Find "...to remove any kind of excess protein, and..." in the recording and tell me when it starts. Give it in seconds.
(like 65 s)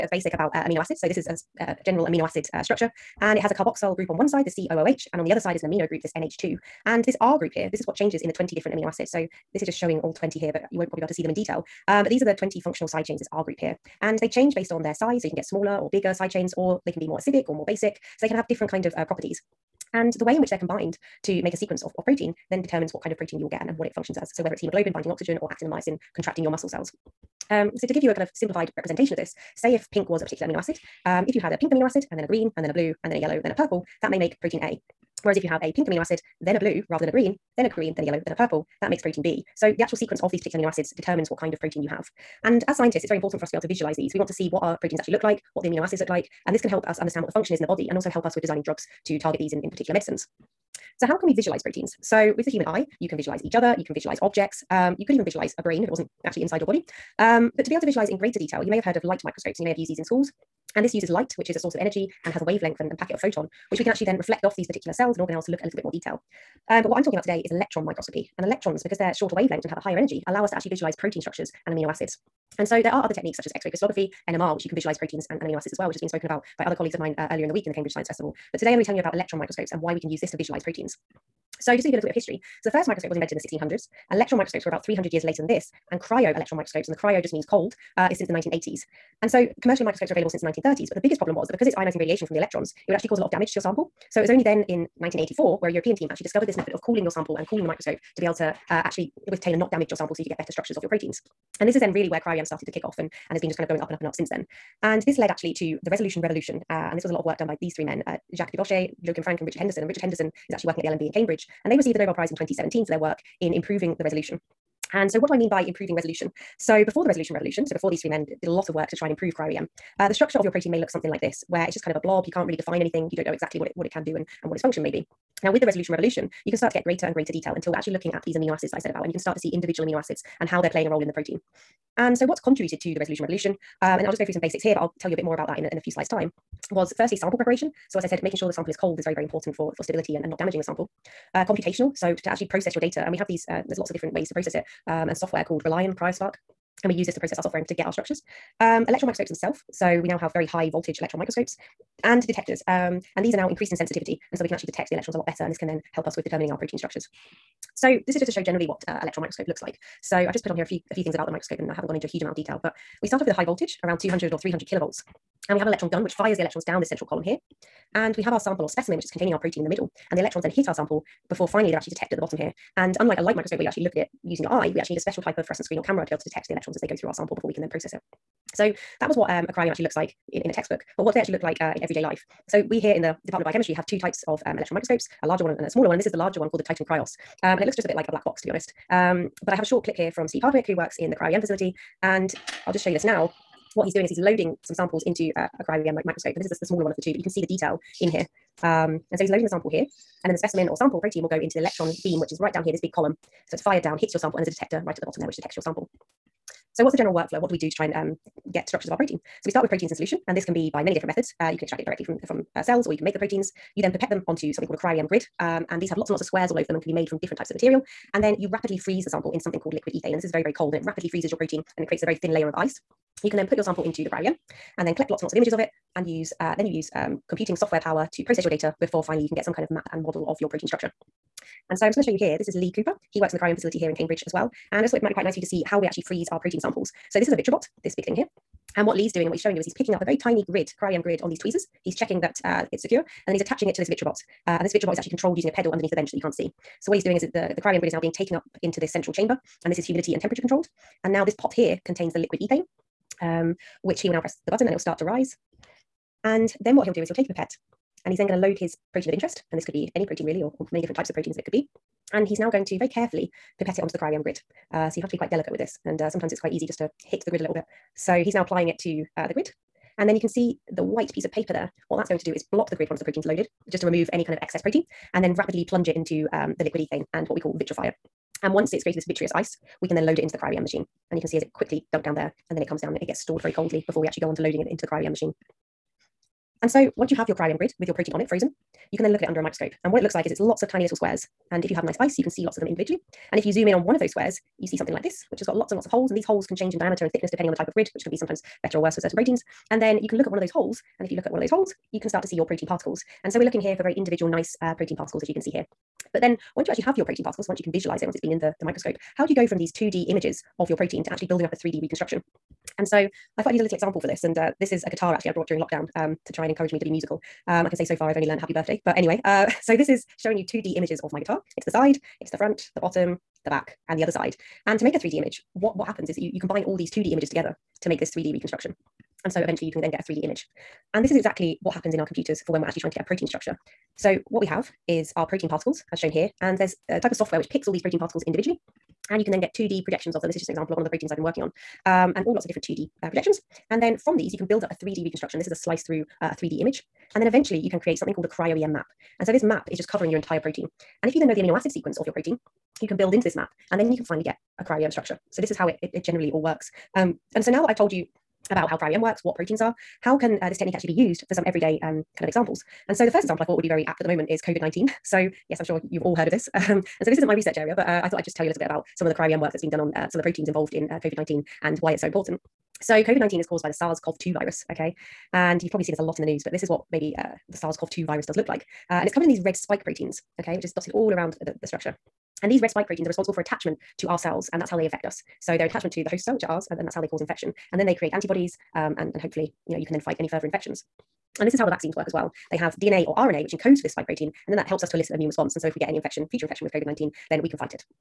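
273 s.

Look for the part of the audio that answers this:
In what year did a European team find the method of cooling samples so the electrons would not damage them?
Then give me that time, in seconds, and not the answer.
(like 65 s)
94 s.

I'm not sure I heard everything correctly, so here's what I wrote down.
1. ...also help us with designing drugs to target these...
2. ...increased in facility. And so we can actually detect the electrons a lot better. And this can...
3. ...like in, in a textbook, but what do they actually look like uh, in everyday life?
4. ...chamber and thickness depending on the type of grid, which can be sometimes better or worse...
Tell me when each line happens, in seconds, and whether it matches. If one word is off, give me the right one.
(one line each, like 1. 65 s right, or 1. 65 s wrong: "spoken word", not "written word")
1. 47 s right
2. 153 s wrong: "sensitivity", not "facility"
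3. 179 s right
4. 296 s wrong: "diameter", not "chamber".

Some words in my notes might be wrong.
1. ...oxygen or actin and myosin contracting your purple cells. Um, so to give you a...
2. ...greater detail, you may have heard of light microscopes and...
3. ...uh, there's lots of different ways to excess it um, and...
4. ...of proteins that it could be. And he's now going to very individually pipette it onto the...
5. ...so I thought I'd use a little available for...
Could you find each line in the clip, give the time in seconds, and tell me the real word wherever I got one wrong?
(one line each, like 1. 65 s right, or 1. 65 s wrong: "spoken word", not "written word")
1. 25 s wrong: "muscle", not "purple"
2. 58 s right
3. 143 s wrong: "process", not "excess"
4. 261 s wrong: "carefully", not "individually"
5. 312 s wrong: "example", not "available".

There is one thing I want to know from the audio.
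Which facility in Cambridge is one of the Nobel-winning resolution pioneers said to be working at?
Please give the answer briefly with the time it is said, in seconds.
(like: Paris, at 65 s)
the LMB, at 110 s.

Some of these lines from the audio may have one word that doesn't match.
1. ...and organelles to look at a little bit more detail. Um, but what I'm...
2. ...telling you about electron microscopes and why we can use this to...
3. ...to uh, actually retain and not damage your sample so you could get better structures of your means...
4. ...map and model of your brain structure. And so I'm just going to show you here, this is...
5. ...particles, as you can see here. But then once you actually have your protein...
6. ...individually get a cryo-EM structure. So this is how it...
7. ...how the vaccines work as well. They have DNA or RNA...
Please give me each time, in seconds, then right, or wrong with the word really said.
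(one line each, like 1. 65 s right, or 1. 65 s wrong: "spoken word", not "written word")
1. 65 s right
2. 78 s right
3. 98 s wrong: "proteins", not "means"
4. 229 s wrong: "protein", not "brain"
5. 304 s right
6. 354 s wrong: "finally", not "individually"
7. 391 s right.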